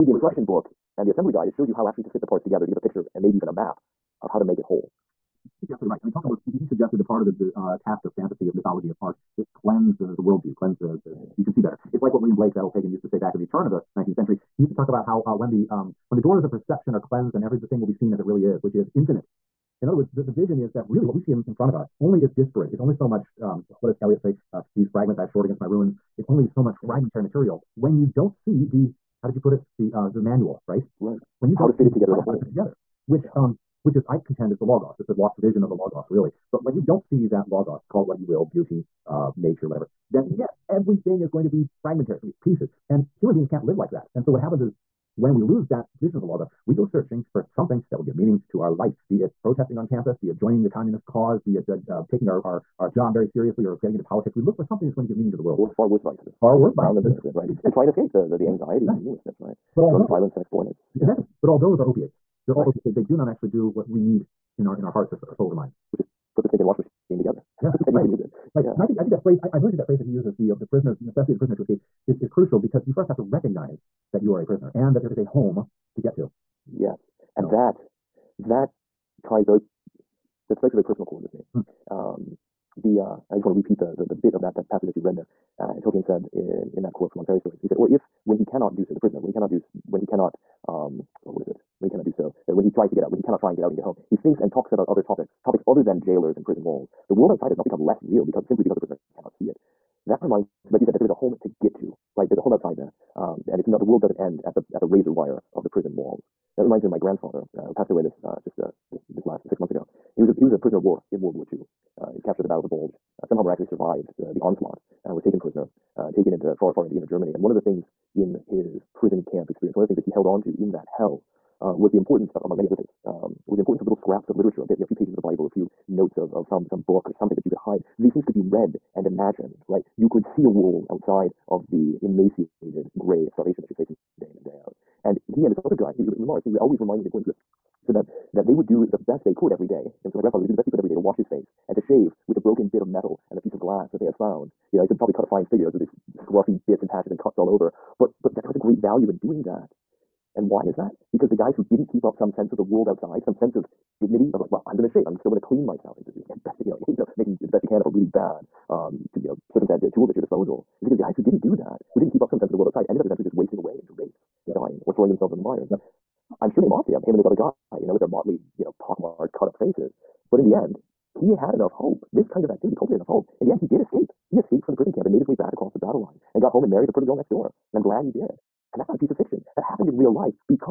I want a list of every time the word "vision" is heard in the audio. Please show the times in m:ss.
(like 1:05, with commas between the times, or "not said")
0:20, 0:35, 0:46.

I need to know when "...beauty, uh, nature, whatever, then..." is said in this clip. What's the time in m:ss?
0:38.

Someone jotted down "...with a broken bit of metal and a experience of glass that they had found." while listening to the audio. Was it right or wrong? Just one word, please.
wrong.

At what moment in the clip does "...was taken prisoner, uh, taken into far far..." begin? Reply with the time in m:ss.
1:55.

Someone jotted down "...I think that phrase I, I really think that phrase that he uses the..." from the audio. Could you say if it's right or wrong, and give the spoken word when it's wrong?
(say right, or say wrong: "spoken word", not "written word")
right.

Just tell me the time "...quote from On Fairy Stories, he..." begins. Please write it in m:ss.
1:26.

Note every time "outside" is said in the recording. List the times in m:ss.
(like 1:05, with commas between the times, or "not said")
1:37, 1:42, 2:10, 2:32, 2:42.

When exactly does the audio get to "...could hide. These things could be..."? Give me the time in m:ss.
2:07.